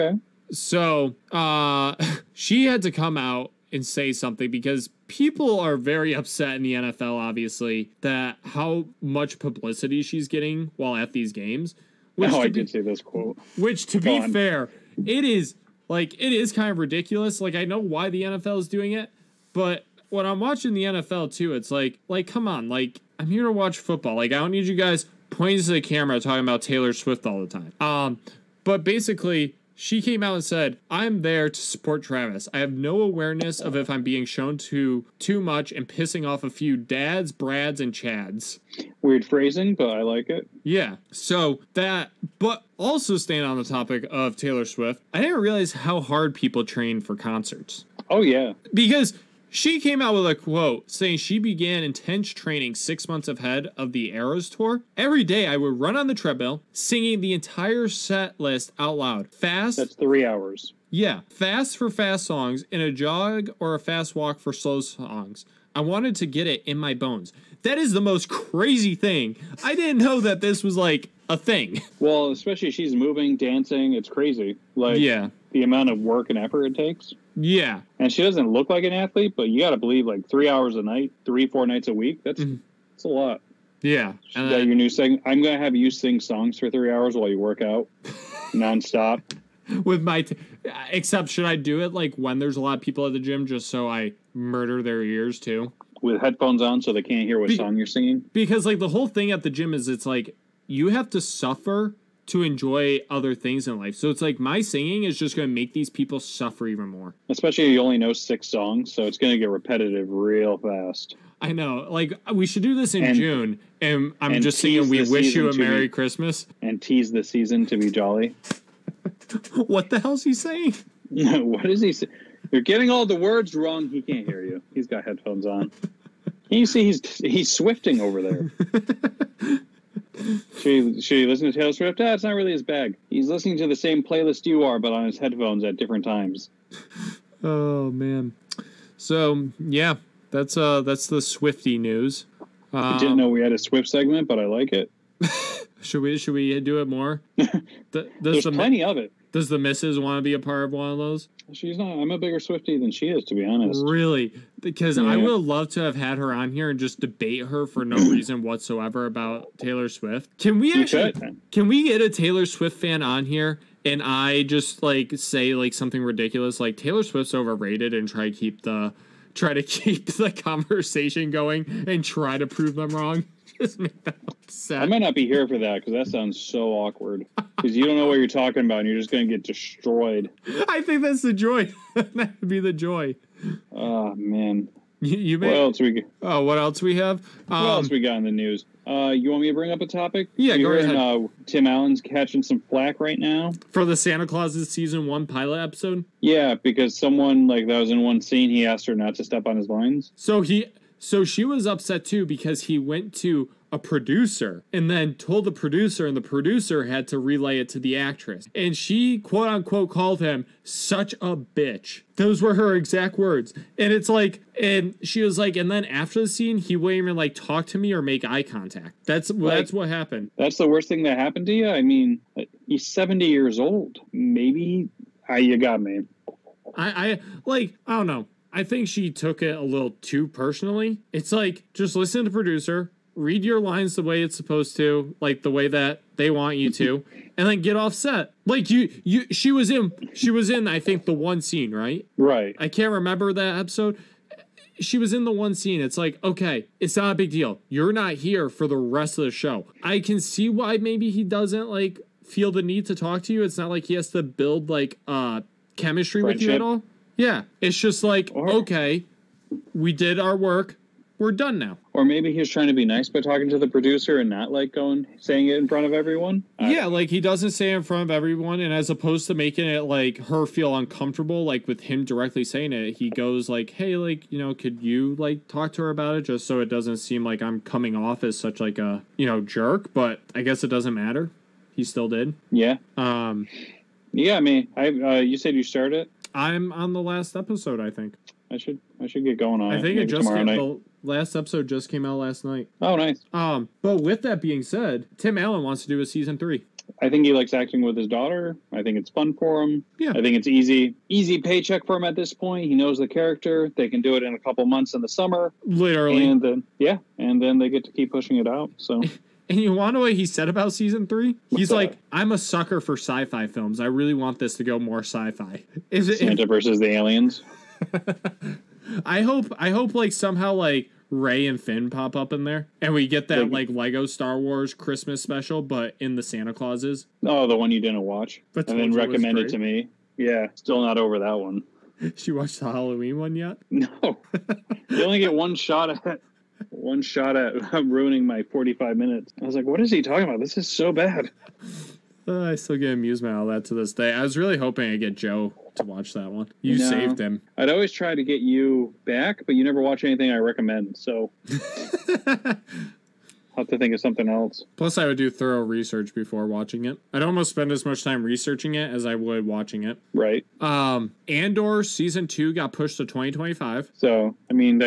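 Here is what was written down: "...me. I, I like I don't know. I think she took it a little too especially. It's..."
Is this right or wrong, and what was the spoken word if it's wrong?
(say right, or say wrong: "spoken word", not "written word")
wrong: "personally", not "especially".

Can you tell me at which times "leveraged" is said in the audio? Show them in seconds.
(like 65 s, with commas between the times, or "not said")
not said.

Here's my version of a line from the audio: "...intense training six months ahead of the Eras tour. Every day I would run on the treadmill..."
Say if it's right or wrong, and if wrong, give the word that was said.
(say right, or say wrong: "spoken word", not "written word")
right.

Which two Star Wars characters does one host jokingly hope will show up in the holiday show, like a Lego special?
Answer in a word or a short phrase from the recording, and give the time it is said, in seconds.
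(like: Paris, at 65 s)
Rey and Finn, at 321 s.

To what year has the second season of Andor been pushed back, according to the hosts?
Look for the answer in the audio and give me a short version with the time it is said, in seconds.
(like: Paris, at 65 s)
2025, at 363 s.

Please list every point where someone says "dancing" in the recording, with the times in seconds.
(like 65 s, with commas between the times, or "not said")
73 s.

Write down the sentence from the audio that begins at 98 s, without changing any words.
Because like the whole thing at the gym is it's like you have to suffer to enjoy other things in life.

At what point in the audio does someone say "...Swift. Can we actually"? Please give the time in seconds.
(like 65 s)
159 s.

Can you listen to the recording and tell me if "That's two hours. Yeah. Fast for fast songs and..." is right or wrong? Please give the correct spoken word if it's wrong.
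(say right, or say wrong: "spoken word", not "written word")
wrong: "three", not "two".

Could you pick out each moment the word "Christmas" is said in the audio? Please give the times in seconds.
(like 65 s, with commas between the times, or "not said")
115 s, 324 s.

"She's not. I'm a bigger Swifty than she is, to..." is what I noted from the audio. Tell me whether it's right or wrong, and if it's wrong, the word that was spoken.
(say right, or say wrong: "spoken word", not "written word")
right.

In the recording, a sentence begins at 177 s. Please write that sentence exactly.
Because you don't know what you're talking about, and you're just going to get destroyed.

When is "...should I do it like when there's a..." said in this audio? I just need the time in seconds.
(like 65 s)
91 s.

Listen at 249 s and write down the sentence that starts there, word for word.
I can see why maybe he doesn't like feel the need to talk to you.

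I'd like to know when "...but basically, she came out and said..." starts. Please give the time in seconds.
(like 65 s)
28 s.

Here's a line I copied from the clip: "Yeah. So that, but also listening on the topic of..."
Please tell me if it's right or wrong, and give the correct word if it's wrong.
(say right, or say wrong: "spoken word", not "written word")
wrong: "staying", not "listening".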